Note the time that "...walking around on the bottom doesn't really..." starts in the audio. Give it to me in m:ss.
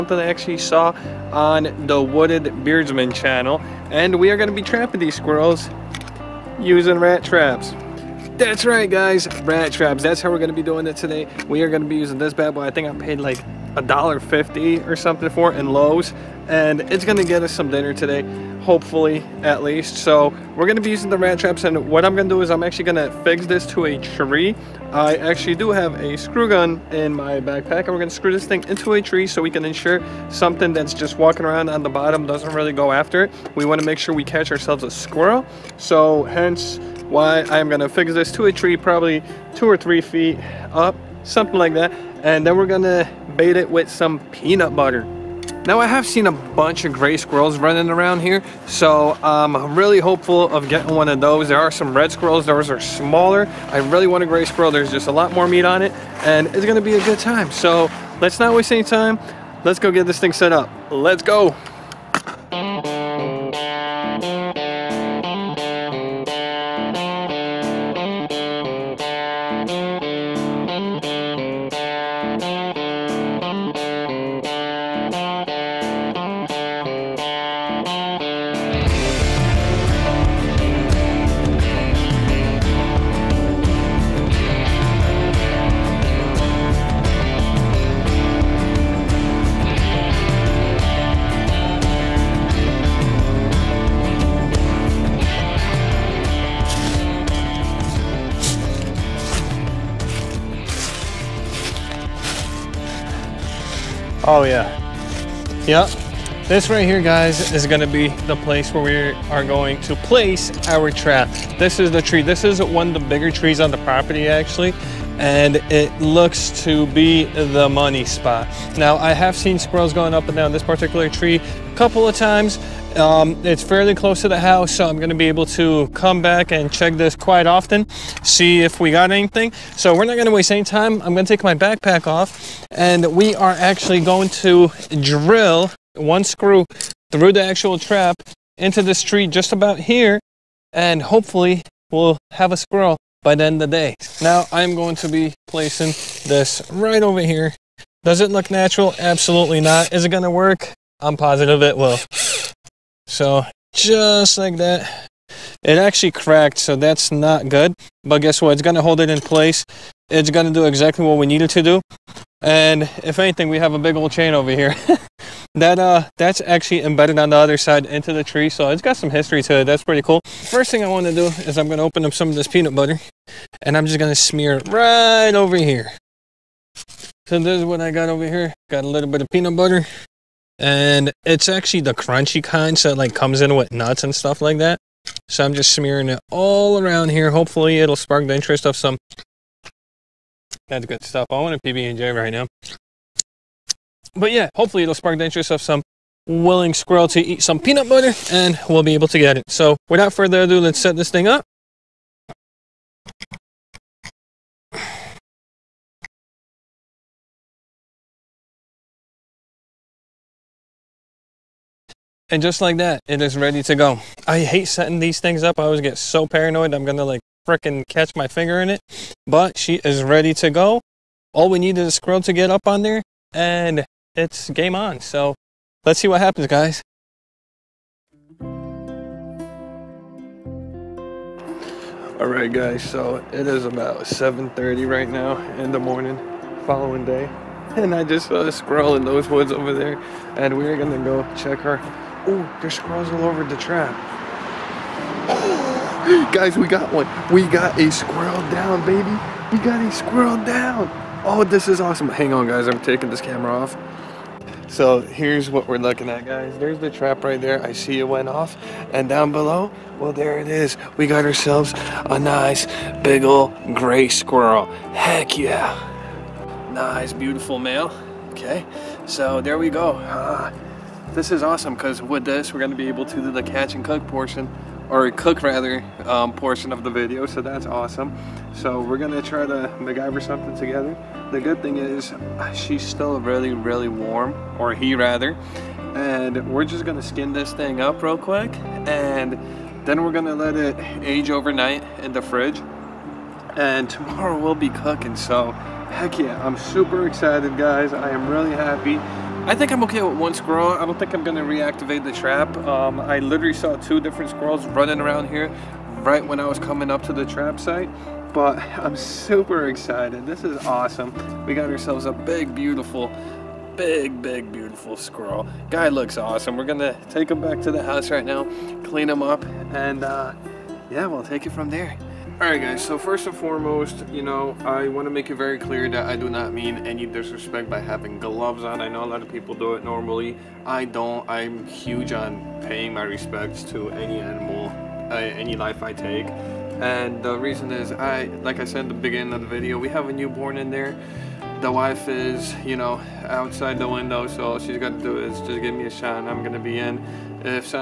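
0:31.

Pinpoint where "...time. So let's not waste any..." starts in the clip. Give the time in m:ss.
0:57.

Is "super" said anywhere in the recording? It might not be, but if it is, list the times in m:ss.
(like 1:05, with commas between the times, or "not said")
4:56, 5:08.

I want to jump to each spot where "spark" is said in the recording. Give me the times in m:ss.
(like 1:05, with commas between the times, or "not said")
3:07, 3:14.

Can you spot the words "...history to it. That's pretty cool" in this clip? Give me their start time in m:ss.
2:49.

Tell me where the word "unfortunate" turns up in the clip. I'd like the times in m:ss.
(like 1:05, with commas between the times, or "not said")
not said.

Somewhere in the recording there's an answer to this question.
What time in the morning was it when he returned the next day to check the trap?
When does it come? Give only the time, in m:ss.
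3:54.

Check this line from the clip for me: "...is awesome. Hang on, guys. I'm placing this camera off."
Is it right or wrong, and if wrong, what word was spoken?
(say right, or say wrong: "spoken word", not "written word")
wrong: "taking", not "placing".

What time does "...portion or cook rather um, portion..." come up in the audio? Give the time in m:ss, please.
4:34.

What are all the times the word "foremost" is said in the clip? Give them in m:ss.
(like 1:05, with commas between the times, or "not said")
5:23.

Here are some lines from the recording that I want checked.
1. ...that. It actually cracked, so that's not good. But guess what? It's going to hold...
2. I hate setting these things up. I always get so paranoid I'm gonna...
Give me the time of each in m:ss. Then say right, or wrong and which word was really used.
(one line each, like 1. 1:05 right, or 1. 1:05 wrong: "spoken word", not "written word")
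1. 2:34 right
2. 3:34 right.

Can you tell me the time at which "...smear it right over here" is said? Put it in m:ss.
2:54.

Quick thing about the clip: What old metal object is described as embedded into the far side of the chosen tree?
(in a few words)
chain.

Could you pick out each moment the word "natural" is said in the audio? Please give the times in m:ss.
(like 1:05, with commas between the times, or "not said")
2:28.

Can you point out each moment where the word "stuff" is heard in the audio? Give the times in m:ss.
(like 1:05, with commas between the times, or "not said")
3:04, 3:11.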